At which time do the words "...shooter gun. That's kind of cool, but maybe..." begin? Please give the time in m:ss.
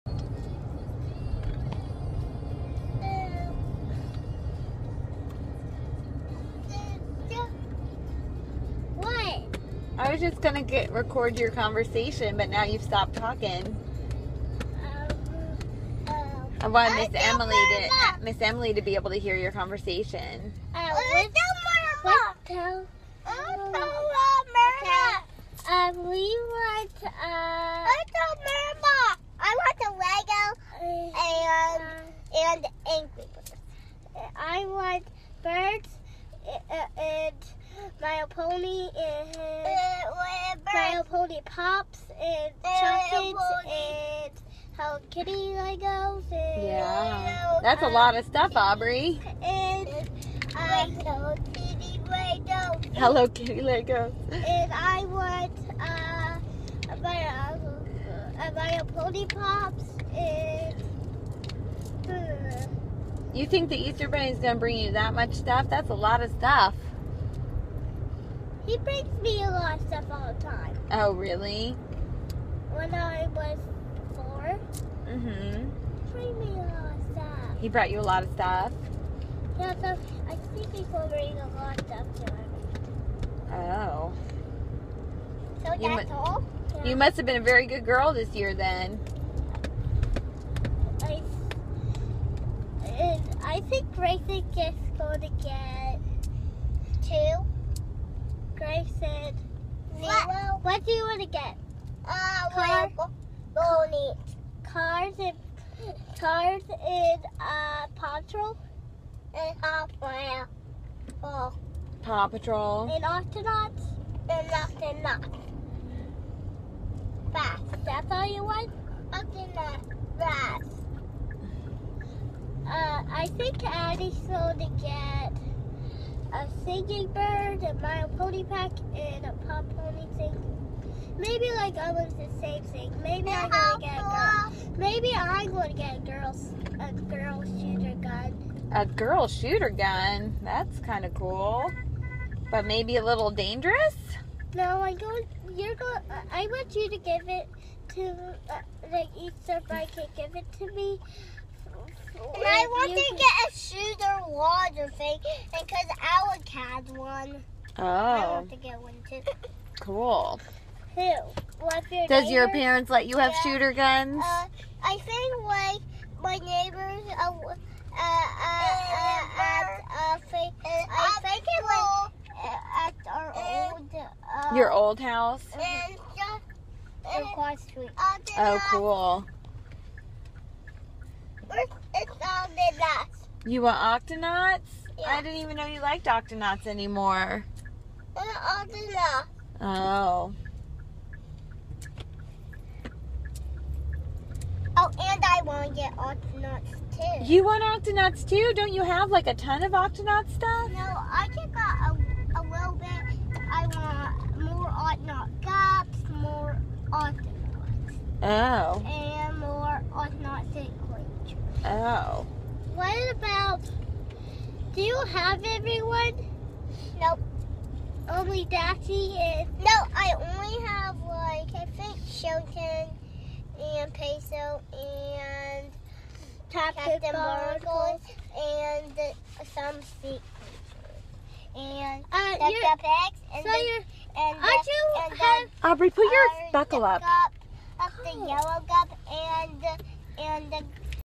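2:19.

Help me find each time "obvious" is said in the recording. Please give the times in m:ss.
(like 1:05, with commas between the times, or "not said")
not said.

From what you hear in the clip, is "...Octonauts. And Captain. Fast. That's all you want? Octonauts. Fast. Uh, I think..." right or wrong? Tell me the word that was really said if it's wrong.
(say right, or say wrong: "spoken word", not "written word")
wrong: "Octonauts", not "Captain".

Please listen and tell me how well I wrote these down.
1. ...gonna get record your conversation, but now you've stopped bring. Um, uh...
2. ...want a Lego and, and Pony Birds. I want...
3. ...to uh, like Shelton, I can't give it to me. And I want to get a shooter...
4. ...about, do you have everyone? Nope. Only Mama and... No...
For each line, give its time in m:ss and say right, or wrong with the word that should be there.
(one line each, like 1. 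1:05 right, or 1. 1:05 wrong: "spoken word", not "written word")
1. 0:10 wrong: "talking", not "bring"
2. 0:29 wrong: "Angry", not "Pony"
3. 2:27 wrong: "Easter", not "Shelton"
4. 3:33 wrong: "Daxie", not "Mama".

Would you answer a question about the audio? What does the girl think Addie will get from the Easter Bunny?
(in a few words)
a singing bird.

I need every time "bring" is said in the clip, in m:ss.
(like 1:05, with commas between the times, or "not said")
1:04, 1:08, 1:20.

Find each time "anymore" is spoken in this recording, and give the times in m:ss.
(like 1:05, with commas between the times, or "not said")
3:06.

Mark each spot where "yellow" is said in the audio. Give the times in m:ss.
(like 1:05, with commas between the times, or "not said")
3:58.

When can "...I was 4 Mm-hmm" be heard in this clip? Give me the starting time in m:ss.
1:12.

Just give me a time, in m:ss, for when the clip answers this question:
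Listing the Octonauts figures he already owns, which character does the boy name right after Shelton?
3:43.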